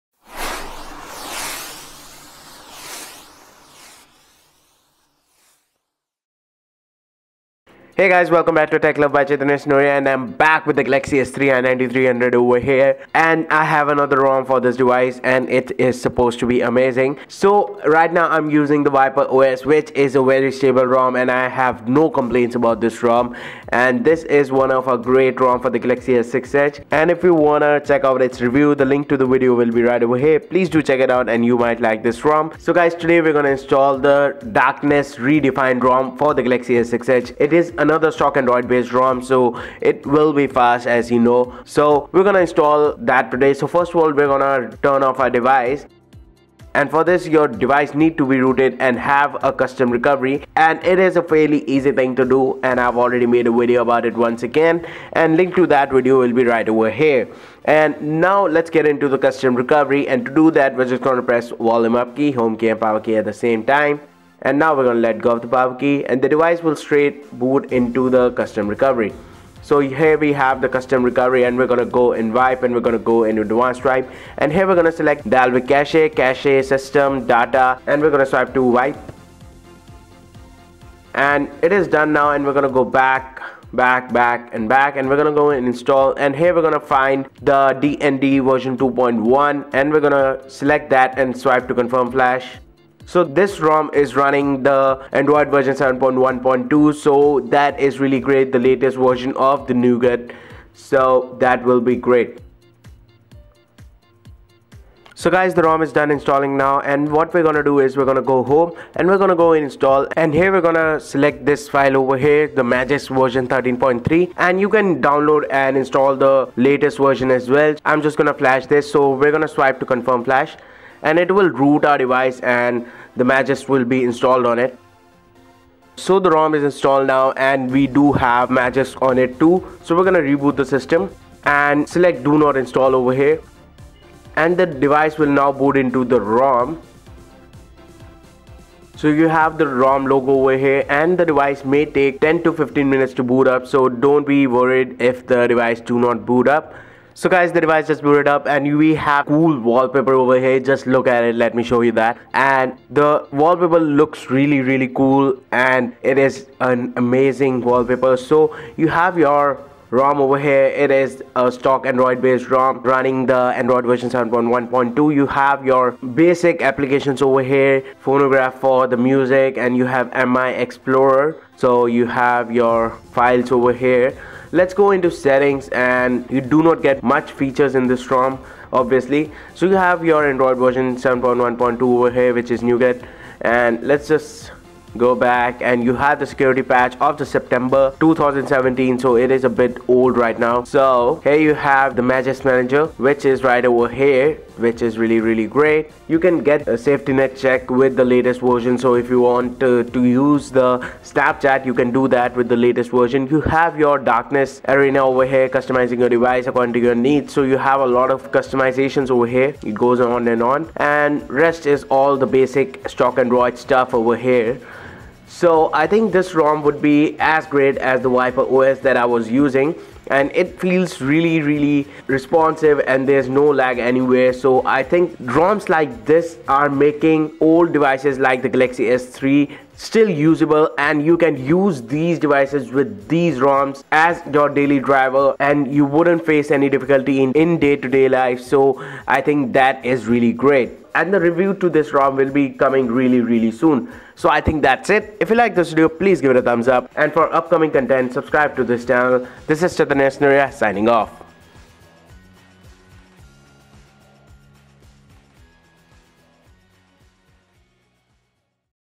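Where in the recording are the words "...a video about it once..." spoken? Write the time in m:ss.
0:53.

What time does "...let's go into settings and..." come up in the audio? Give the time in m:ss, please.
2:54.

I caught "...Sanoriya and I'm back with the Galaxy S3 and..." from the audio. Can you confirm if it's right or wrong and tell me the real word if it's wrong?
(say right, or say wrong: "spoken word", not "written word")
right.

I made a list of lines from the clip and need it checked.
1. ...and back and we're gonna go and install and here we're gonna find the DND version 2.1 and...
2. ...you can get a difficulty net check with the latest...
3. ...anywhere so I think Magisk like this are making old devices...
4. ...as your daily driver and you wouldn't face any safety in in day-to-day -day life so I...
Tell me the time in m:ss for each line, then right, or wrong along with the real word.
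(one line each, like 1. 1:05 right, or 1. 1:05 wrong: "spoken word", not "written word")
1. 1:24 right
2. 3:16 wrong: "safety", not "difficulty"
3. 3:43 wrong: "ROMs", not "Magisk"
4. 3:53 wrong: "difficulty", not "safety".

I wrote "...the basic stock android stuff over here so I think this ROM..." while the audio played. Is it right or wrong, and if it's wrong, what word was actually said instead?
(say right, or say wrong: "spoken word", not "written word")
right.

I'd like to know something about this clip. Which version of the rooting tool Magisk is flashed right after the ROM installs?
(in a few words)
13.3.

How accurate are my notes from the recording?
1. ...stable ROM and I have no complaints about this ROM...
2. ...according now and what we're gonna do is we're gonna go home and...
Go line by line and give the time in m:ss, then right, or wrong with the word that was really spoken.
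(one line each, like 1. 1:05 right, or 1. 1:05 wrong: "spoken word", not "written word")
1. 0:20 right
2. 1:46 wrong: "installing", not "according".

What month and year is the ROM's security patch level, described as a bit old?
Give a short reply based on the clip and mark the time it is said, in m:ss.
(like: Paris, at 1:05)
September 2017, at 3:07.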